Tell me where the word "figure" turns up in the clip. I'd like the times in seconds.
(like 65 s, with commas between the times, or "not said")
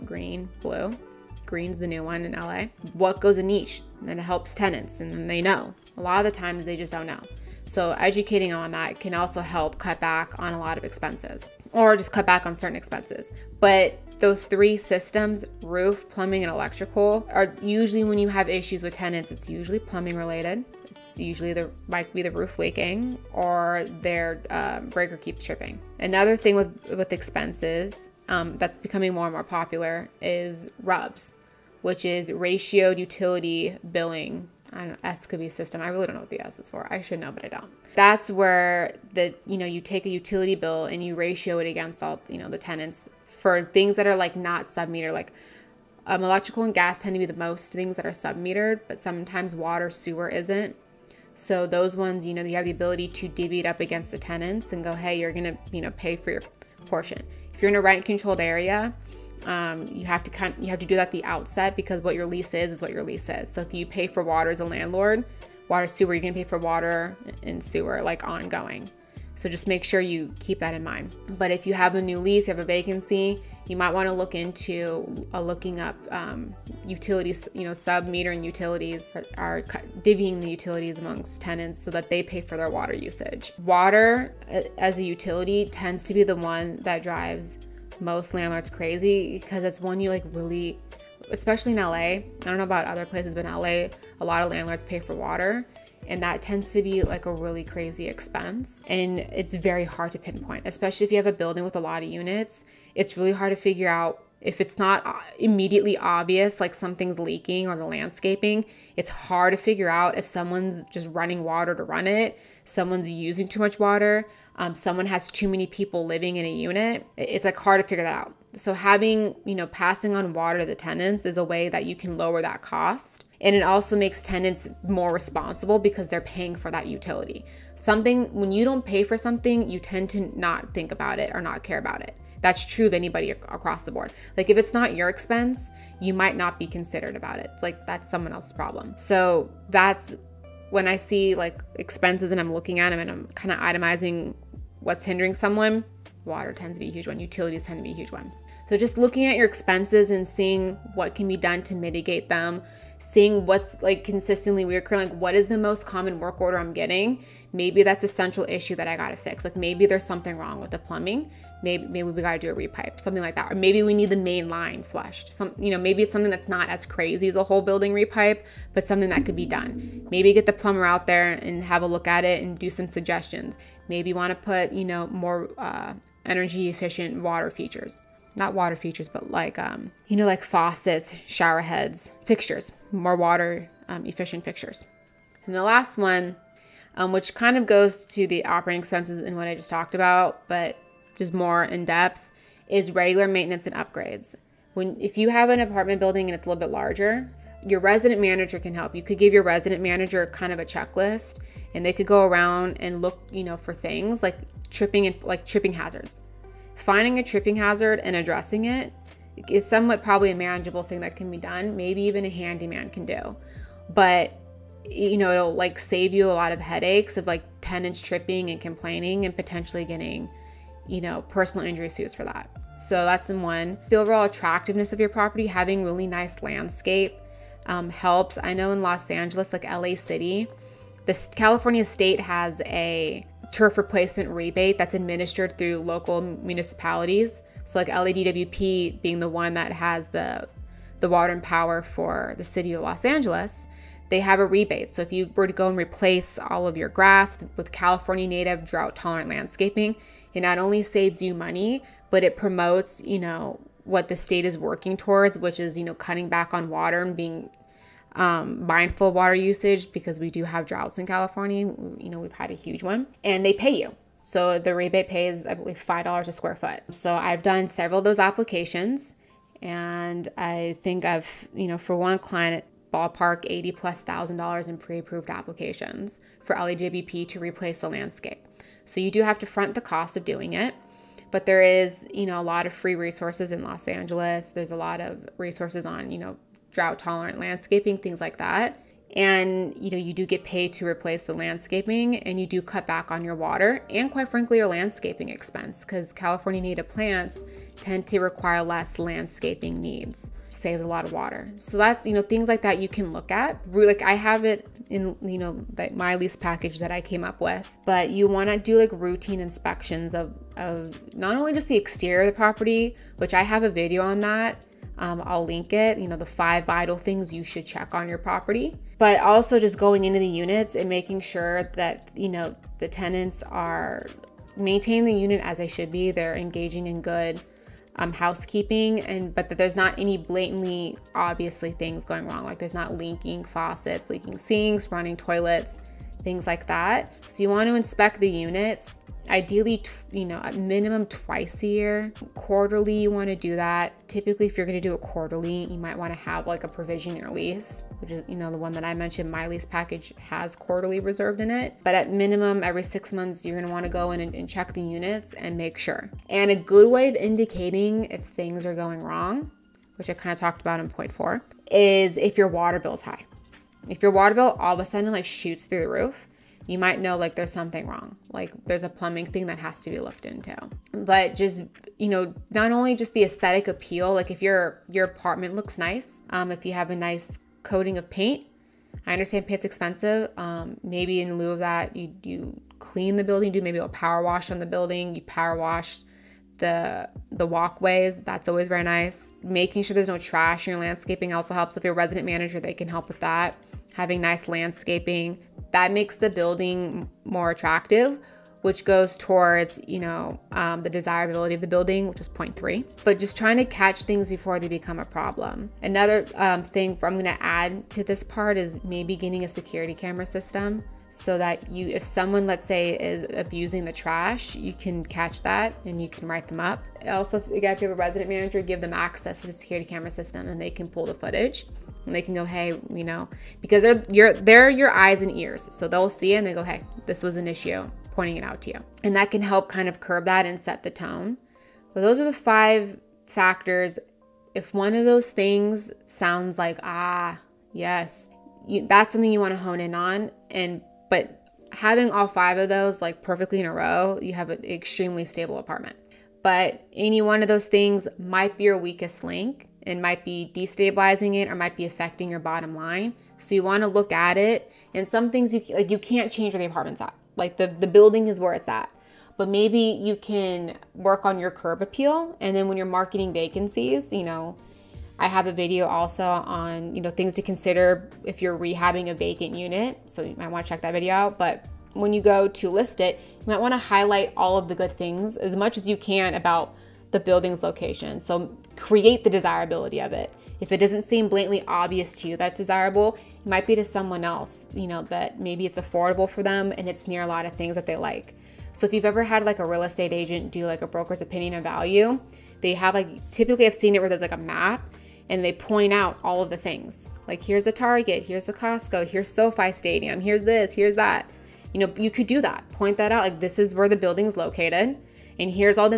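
103 s, 109 s, 117 s.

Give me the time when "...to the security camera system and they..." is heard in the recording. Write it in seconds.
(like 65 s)
419 s.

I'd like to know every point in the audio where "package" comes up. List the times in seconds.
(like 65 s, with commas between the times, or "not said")
306 s, 349 s.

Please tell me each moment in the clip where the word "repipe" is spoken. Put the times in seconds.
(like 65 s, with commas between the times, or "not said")
162 s, 167 s.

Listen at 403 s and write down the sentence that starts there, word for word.
But just trying to catch things before they become a problem.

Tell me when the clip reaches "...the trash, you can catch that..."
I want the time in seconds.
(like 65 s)
413 s.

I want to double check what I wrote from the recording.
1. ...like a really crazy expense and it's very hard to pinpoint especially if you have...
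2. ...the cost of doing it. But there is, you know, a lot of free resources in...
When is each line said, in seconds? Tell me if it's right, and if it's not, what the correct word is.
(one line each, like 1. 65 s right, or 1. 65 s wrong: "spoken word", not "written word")
1. 97 s right
2. 279 s right.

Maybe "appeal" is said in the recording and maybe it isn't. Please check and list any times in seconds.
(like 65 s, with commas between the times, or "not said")
373 s, 461 s.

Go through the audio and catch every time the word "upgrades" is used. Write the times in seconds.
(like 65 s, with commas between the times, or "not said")
193 s.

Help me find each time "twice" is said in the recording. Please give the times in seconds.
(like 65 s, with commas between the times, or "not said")
341 s.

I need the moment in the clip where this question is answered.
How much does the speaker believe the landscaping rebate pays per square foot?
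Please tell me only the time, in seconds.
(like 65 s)
265 s.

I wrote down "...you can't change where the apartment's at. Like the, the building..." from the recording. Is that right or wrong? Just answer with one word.
right.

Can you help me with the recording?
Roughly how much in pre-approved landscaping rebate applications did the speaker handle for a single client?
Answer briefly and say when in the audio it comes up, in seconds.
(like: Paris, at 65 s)
$80,000, at 273 s.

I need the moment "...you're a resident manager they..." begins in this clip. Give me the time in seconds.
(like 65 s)
391 s.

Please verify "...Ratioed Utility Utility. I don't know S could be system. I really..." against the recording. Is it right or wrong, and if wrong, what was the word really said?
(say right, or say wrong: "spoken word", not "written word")
wrong: "Billing", not "Utility".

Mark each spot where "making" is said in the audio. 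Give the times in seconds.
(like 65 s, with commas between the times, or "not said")
320 s, 389 s.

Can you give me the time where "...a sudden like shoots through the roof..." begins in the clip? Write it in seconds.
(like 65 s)
364 s.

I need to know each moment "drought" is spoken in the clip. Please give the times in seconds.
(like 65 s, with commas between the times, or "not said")
248 s, 260 s, 286 s.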